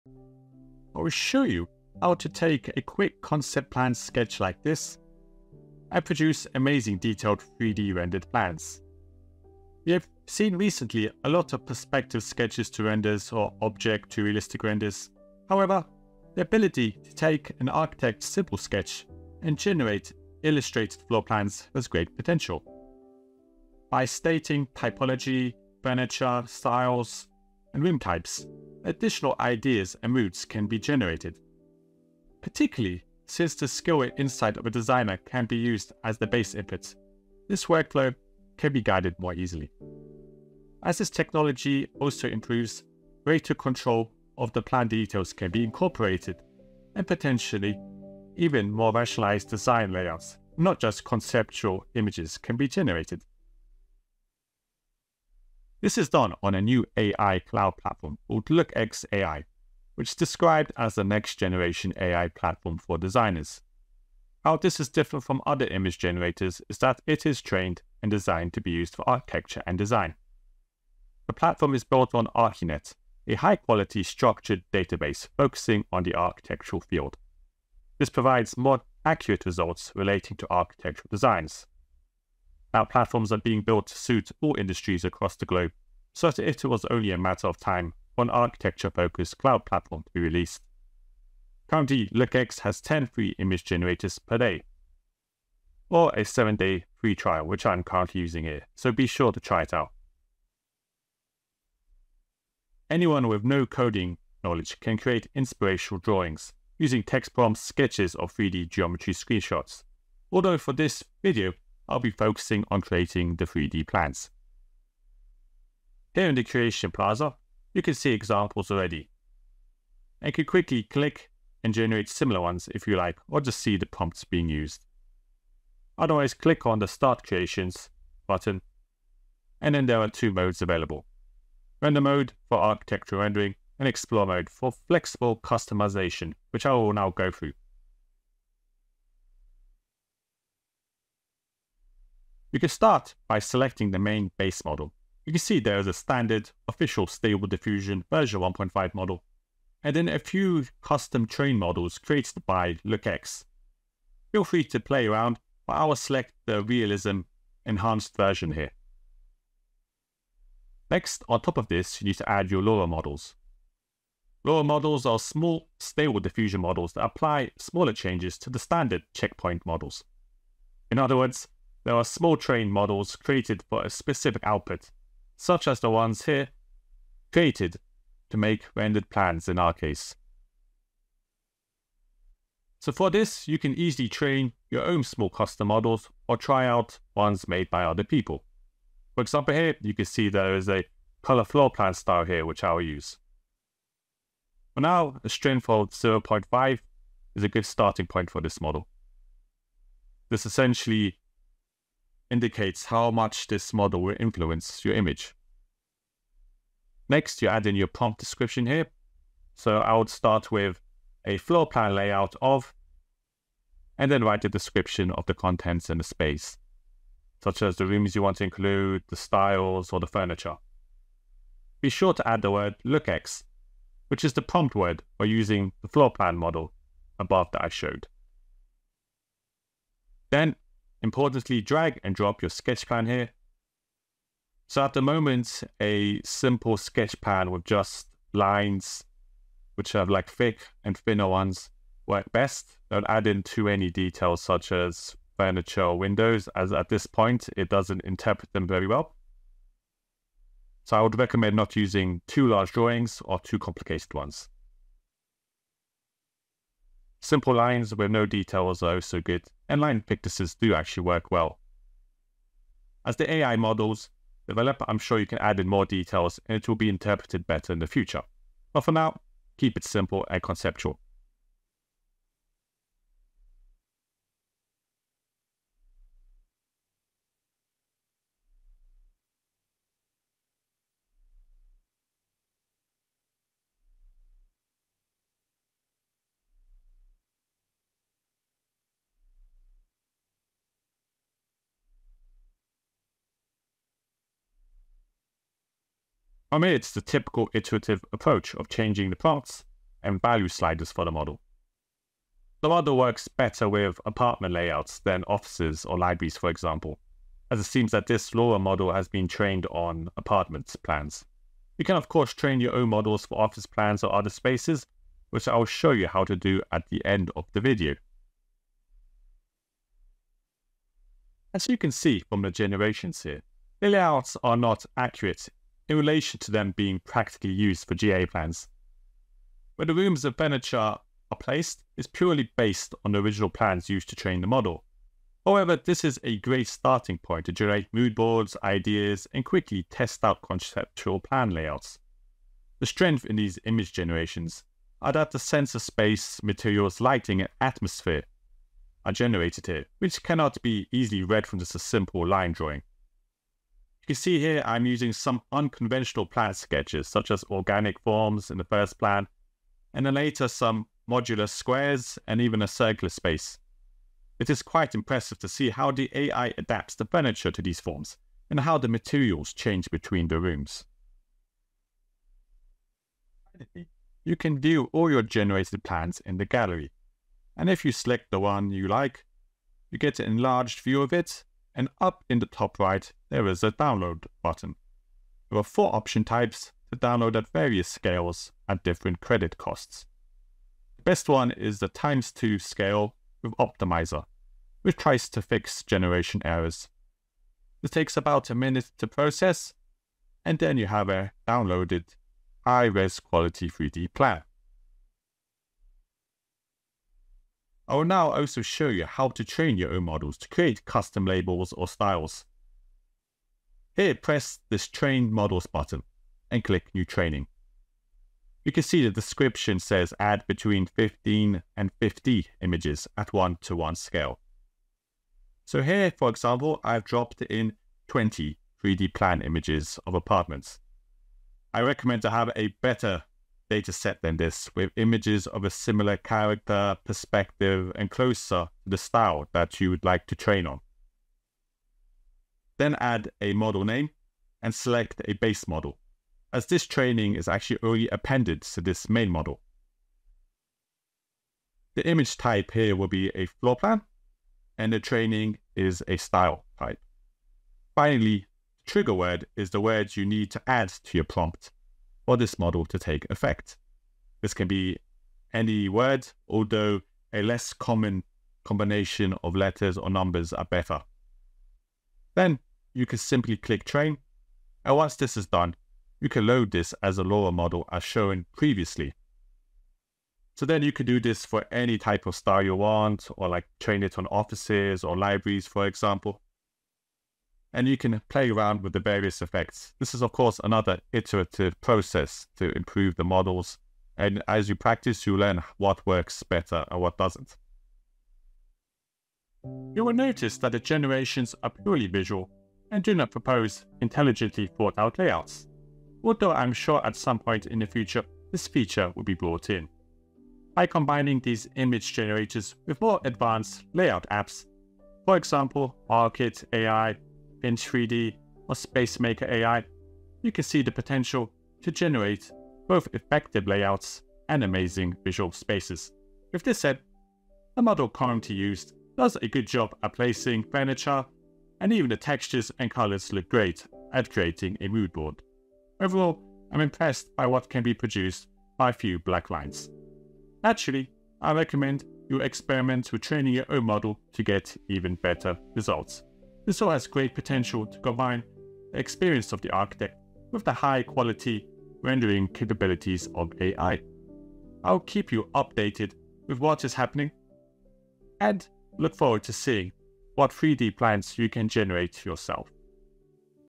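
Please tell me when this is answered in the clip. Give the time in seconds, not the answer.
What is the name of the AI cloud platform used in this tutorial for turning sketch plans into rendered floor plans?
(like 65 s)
58 s.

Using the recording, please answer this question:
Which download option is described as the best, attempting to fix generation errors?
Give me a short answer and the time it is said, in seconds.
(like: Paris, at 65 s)
times 2 scale with Optimizer, at 391 s.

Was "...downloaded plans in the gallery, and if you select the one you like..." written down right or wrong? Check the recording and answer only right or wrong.
wrong.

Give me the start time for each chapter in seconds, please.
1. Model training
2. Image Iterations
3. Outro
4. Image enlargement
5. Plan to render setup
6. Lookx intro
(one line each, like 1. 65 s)
1. 417 s
2. 321 s
3. 500 s
4. 372 s
5. 129 s
6. 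55 s.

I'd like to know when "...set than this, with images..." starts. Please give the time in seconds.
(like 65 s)
433 s.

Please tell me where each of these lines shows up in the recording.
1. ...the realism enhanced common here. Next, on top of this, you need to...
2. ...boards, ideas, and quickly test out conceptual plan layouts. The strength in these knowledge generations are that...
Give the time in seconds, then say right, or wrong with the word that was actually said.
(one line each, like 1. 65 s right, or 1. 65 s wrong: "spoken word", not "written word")
1. 156 s wrong: "version", not "common"
2. 338 s wrong: "image", not "knowledge".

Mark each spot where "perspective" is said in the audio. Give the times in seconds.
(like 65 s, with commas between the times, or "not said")
11 s, 437 s.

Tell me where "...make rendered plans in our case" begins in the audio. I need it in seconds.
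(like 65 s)
178 s.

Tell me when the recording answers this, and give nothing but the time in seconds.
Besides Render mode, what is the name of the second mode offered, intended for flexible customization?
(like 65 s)
133 s.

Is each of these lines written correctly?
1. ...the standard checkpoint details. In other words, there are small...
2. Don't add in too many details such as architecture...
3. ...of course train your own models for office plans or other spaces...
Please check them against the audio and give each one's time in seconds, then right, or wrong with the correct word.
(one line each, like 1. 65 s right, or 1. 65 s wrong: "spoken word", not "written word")
1. 168 s wrong: "models", not "details"
2. 242 s wrong: "furniture", not "architecture"
3. 311 s right.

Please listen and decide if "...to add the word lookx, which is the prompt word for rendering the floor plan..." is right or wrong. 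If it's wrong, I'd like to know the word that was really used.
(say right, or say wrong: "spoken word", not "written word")
wrong: "using", not "rendering".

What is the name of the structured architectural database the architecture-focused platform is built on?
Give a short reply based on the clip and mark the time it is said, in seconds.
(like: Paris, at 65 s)
ArchiNet, at 72 s.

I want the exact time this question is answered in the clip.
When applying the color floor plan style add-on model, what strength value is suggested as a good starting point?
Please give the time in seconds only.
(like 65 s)
195 s.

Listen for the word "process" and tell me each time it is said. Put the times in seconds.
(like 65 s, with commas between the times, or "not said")
399 s, 491 s.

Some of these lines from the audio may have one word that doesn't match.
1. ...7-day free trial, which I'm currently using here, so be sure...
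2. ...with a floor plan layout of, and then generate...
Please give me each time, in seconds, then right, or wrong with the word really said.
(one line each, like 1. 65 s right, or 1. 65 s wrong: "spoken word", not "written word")
1. 96 s right
2. 210 s wrong: "write", not "generate".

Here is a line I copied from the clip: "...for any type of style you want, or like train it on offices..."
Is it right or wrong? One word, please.
right.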